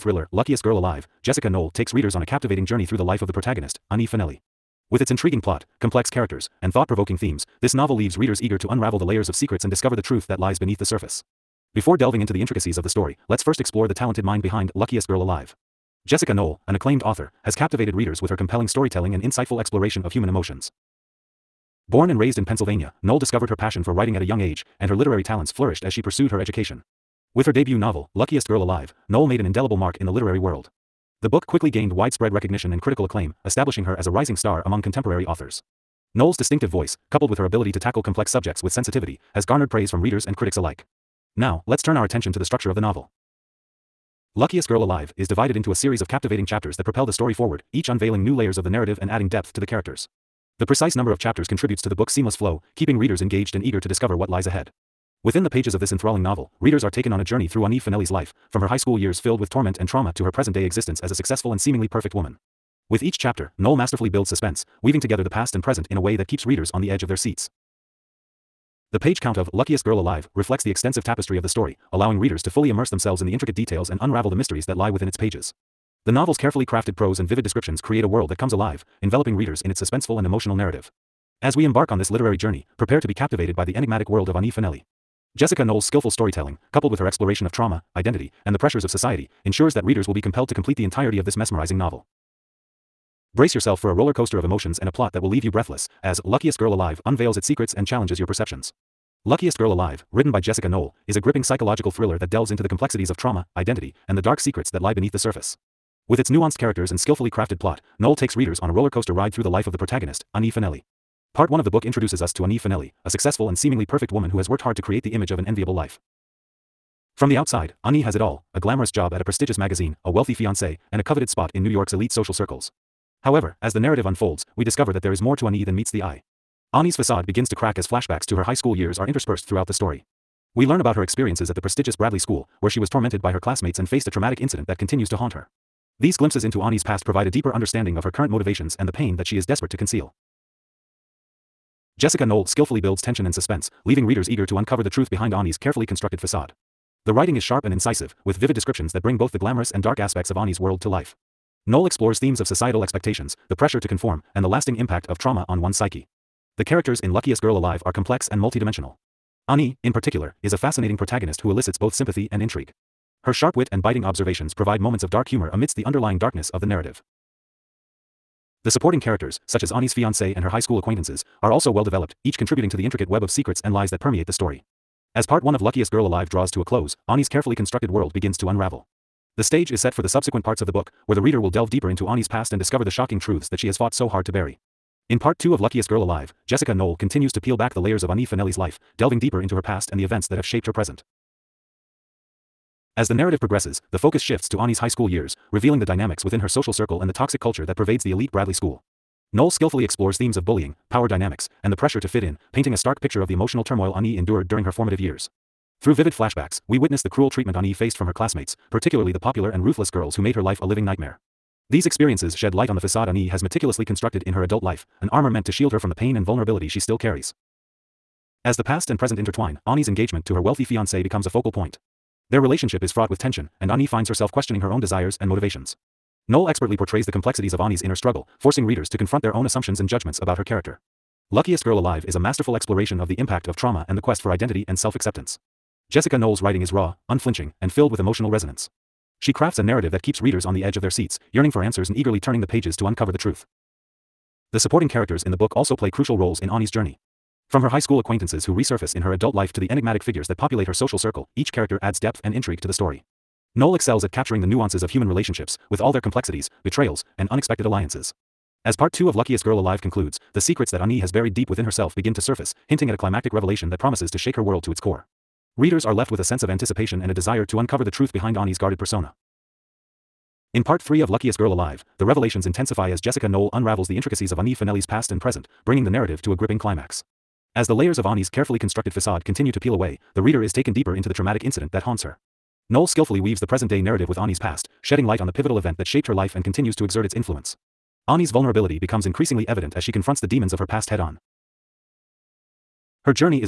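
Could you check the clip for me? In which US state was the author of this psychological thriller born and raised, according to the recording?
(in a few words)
Pennsylvania.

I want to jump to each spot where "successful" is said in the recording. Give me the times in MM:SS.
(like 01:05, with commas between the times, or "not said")
01:01, 01:53.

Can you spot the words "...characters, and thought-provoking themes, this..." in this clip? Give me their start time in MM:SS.
00:06.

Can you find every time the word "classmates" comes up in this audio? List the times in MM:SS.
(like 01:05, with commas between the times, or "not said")
02:13, 03:28.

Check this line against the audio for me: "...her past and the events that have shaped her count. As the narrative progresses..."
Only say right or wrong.
wrong.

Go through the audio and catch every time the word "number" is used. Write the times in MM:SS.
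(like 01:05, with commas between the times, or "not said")
00:50.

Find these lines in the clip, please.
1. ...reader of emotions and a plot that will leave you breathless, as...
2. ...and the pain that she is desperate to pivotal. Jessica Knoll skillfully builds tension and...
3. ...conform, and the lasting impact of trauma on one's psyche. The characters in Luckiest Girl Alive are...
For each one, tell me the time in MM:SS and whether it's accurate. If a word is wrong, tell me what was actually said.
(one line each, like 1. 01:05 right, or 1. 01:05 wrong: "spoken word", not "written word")
1. 01:34 wrong: "coaster", not "reader"
2. 02:18 wrong: "conceal", not "pivotal"
3. 02:33 right.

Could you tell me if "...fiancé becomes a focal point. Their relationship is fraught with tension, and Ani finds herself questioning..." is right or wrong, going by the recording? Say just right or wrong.
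right.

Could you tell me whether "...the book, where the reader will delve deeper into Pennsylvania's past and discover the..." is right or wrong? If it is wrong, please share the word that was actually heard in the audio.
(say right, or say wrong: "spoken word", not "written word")
wrong: "Ani", not "Pennsylvania".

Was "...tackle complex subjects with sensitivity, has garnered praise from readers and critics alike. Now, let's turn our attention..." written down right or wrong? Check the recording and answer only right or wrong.
right.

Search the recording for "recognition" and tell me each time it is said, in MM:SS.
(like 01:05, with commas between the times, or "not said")
00:32.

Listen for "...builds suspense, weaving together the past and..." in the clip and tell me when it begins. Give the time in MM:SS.
01:04.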